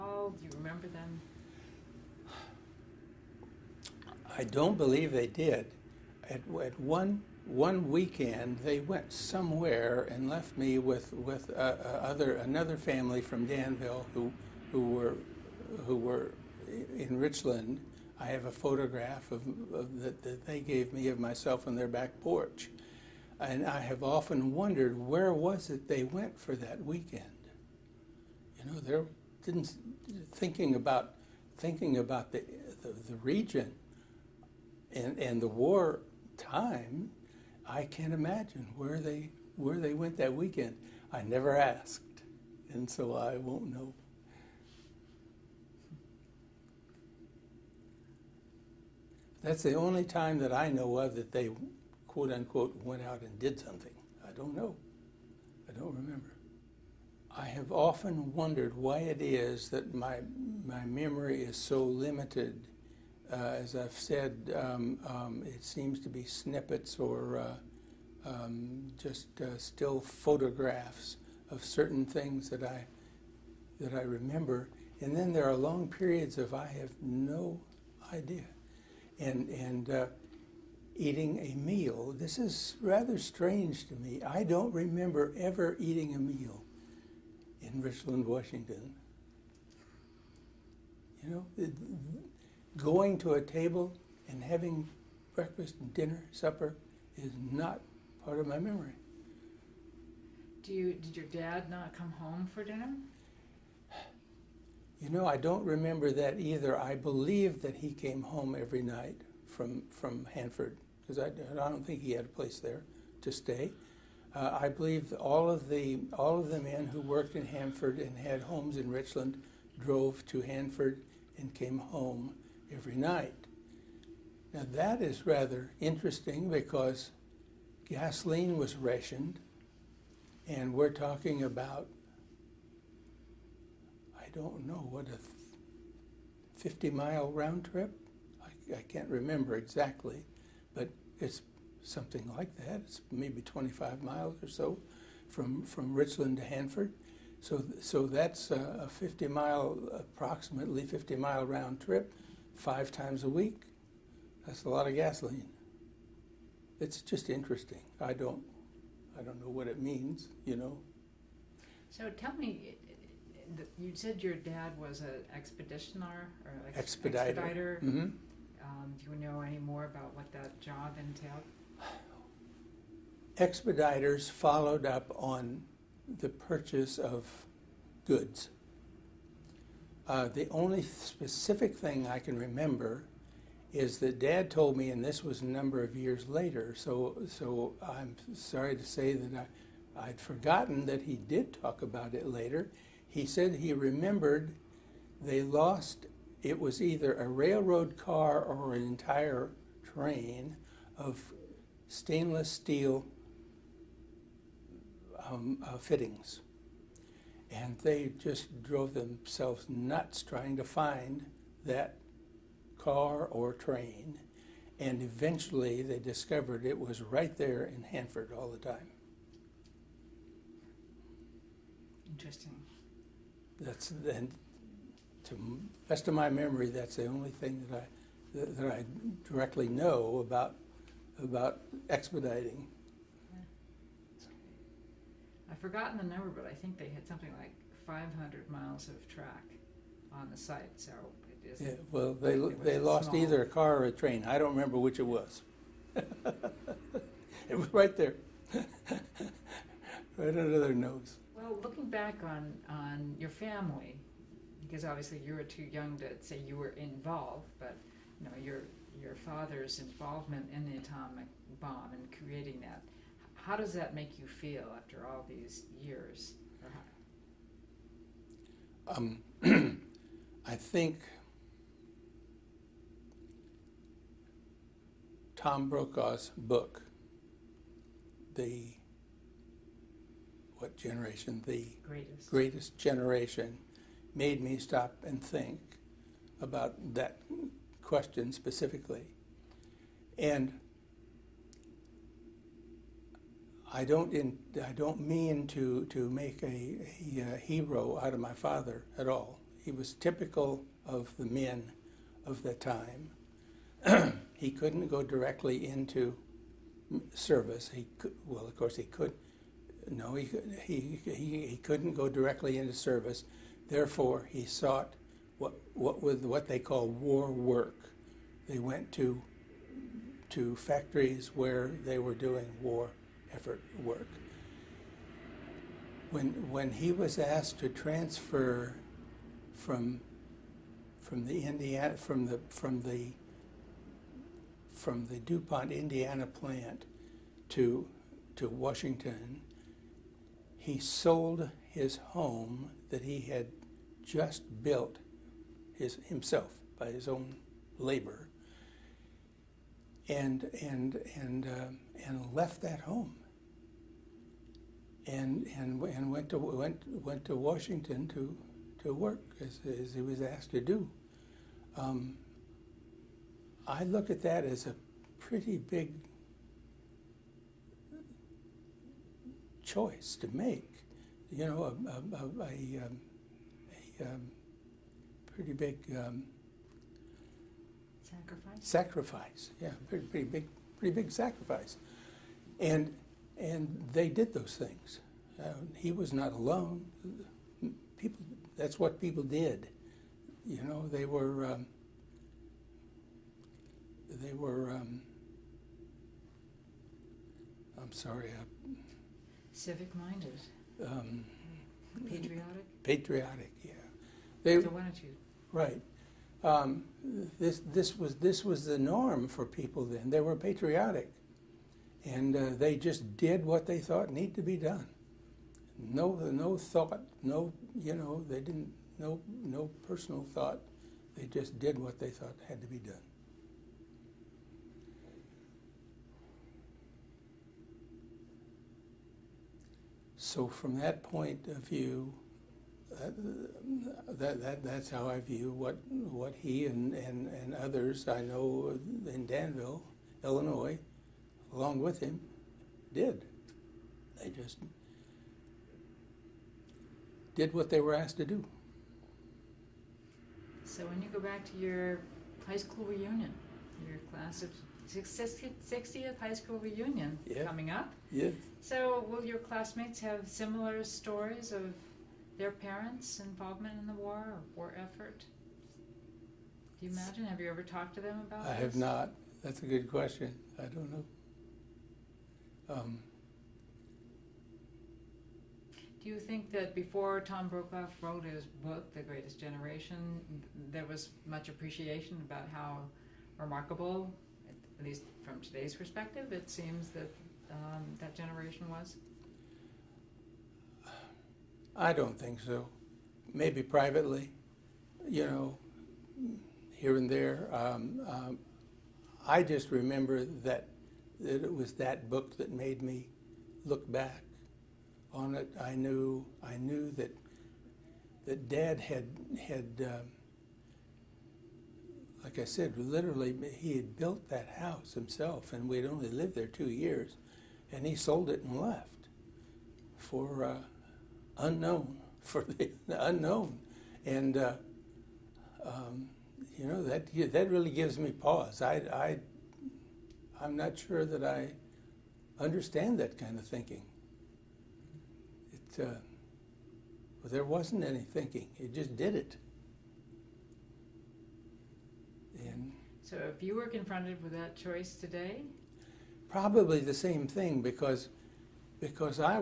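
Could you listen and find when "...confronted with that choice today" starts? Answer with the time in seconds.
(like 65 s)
543 s.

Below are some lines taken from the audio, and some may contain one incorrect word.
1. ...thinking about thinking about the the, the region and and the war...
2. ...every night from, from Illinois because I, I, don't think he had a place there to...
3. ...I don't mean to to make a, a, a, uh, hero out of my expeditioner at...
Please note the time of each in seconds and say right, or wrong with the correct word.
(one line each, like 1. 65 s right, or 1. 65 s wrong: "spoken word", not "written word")
1. 30 s right
2. 108 s wrong: "Hanford", not "Illinois"
3. 294 s wrong: "father", not "expeditioner".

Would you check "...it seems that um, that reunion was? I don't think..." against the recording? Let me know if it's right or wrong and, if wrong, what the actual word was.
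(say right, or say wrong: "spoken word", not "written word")
wrong: "generation", not "reunion".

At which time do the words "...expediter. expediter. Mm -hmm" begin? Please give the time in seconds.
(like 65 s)
166 s.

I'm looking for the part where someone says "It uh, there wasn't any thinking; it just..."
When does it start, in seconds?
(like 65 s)
535 s.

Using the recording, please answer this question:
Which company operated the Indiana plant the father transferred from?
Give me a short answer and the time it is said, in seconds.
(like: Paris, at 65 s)
DuPont, at 335 s.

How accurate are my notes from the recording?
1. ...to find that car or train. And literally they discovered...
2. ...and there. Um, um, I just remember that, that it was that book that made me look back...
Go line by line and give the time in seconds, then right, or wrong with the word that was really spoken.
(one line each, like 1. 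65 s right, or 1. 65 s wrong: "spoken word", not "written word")
1. 210 s wrong: "eventually", not "literally"
2. 496 s right.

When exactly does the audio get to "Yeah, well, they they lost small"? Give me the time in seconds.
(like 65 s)
241 s.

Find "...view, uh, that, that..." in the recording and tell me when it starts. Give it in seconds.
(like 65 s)
431 s.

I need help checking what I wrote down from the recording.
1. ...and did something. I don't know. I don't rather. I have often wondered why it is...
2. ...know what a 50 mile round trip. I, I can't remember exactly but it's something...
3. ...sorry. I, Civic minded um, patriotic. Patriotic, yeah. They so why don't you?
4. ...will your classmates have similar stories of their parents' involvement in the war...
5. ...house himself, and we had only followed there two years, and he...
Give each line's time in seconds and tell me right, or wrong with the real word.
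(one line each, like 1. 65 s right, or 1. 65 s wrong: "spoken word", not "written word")
1. 53 s wrong: "remember", not "rather"
2. 134 s right
3. 397 s right
4. 459 s right
5. 514 s wrong: "lived", not "followed".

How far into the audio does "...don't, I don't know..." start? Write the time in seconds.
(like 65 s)
158 s.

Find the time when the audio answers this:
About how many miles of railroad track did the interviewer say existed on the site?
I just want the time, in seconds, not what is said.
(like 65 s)
237 s.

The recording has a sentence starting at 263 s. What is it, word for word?
How does that make you feel after all these years?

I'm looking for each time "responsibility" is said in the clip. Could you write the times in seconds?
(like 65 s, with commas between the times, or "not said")
not said.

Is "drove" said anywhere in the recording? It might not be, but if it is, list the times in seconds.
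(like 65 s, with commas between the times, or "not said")
119 s, 208 s.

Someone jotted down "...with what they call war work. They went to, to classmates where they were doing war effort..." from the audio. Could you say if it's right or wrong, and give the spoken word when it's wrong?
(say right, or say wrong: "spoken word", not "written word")
wrong: "factories", not "classmates".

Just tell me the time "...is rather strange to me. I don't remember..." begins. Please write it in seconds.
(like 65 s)
82 s.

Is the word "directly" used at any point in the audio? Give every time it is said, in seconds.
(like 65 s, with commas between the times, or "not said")
229 s, 305 s, 312 s.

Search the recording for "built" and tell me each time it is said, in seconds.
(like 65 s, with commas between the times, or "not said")
344 s, 513 s.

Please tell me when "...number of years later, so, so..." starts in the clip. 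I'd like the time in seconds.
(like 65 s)
185 s.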